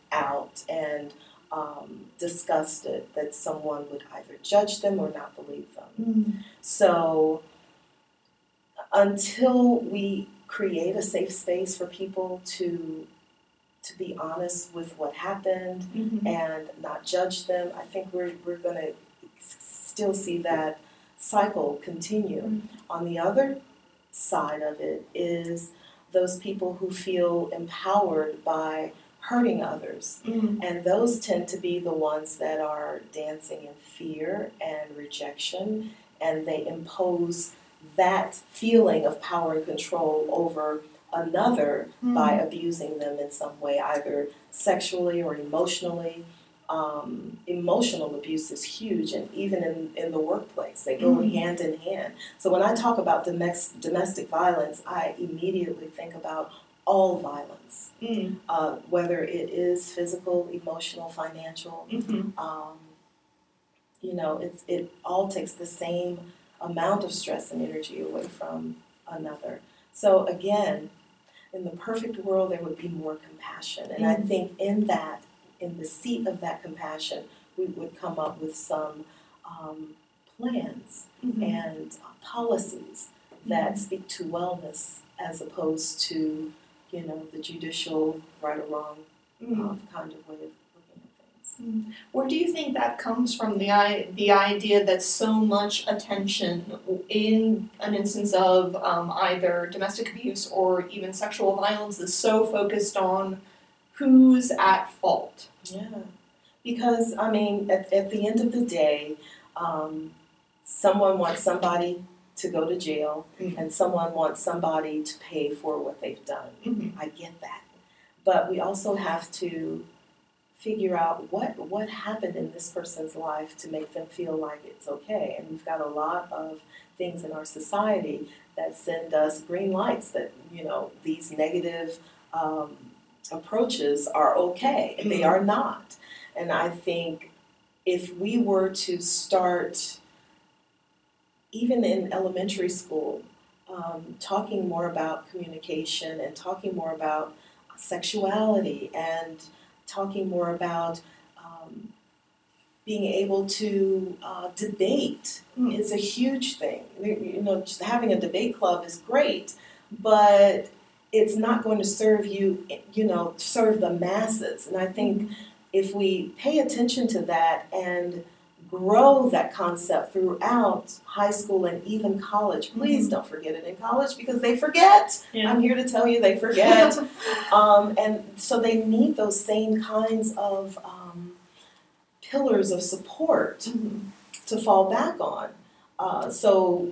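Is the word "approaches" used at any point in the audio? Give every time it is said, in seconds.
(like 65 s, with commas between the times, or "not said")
133 s.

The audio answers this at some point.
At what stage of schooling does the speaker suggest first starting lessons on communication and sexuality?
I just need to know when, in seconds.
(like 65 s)
142 s.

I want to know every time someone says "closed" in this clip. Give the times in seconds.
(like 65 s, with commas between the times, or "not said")
not said.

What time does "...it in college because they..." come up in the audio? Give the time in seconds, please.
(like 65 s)
173 s.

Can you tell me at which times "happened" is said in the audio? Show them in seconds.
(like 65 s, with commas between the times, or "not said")
15 s, 121 s.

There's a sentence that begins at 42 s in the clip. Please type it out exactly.
by abusing them in some way, either sexually or emotionally.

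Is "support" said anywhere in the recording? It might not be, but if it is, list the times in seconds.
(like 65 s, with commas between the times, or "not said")
182 s.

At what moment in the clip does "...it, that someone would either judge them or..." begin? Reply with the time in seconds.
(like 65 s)
2 s.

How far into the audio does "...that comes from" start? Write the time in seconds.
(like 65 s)
92 s.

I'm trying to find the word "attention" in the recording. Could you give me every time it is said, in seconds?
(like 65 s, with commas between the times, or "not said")
95 s, 166 s.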